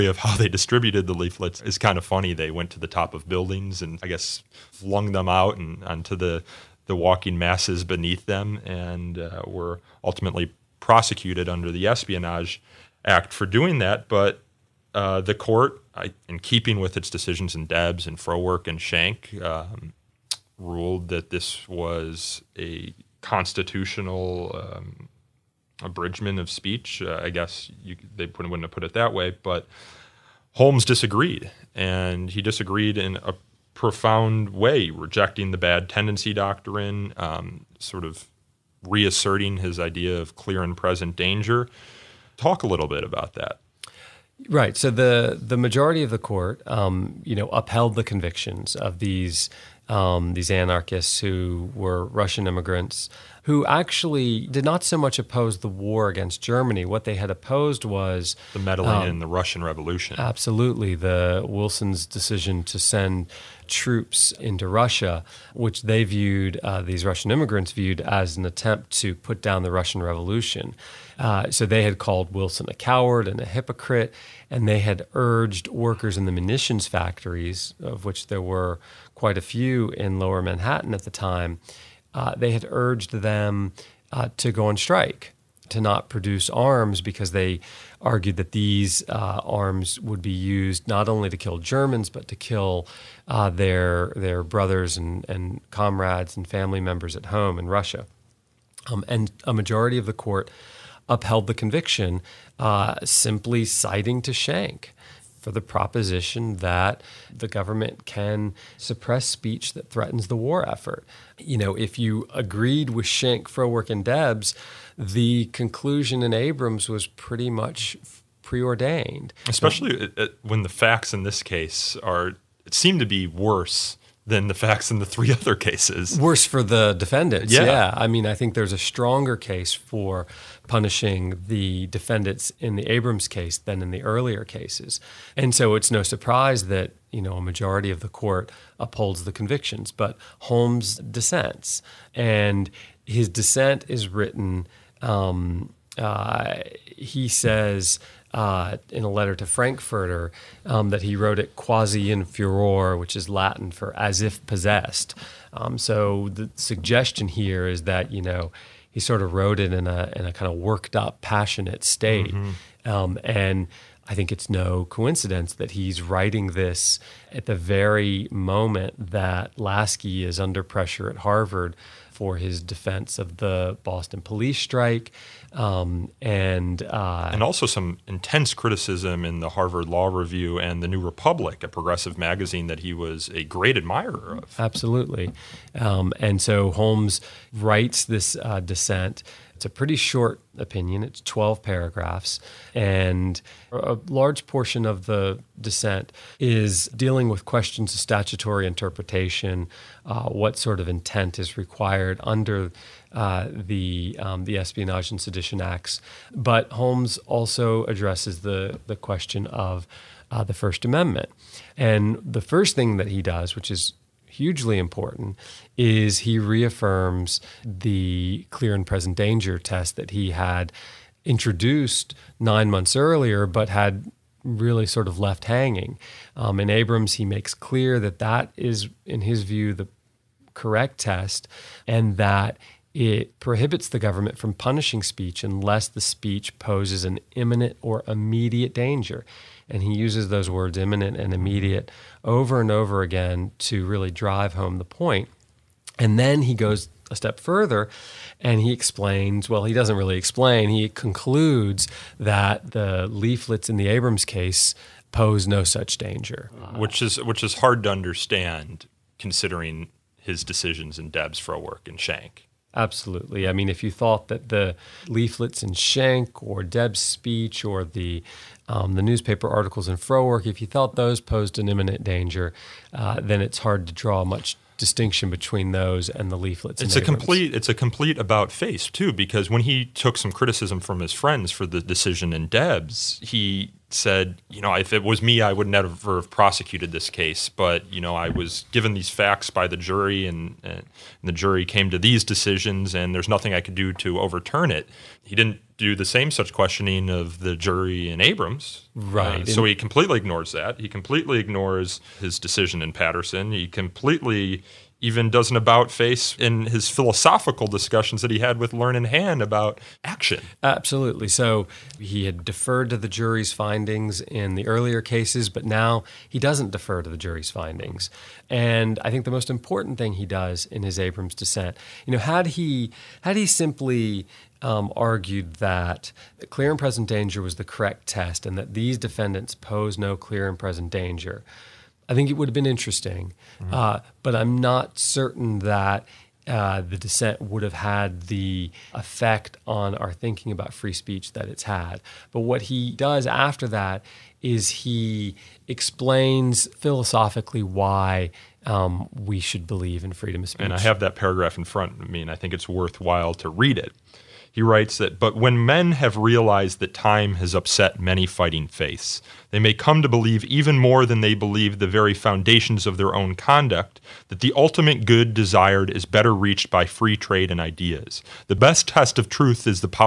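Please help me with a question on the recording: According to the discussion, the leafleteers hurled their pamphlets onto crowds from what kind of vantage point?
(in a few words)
Top of buildings.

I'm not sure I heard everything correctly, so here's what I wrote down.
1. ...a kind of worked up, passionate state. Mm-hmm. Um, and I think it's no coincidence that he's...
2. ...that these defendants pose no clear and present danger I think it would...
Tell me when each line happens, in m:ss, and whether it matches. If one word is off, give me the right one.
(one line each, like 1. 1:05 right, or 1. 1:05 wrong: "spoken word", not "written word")
1. 2:40 right
2. 5:28 right.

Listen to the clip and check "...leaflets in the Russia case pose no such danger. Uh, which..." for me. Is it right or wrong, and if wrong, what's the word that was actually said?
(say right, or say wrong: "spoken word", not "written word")
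wrong: "Abrams", not "Russia".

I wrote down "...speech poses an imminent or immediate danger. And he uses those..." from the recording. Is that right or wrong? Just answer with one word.
right.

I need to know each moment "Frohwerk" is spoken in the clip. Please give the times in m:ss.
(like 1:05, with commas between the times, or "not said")
0:18, 1:53, 4:29.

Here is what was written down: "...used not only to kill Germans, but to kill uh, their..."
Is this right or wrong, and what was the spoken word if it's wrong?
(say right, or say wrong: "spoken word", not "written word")
right.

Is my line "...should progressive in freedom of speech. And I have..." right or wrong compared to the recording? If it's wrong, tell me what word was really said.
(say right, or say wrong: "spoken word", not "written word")
wrong: "believe", not "progressive".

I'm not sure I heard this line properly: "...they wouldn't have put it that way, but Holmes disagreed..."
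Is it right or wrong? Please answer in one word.
right.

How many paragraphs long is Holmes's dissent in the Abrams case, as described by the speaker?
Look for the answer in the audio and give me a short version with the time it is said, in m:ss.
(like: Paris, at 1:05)
12, at 3:11.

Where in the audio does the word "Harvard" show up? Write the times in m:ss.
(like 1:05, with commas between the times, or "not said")
2:51, 2:59.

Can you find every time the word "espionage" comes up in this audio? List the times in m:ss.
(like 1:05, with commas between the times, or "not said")
0:11, 3:24.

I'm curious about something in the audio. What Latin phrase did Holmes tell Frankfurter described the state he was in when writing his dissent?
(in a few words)
Quasi in furor.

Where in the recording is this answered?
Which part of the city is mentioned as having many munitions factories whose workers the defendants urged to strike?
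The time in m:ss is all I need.
1:20.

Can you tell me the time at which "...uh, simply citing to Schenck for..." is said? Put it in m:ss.
1:42.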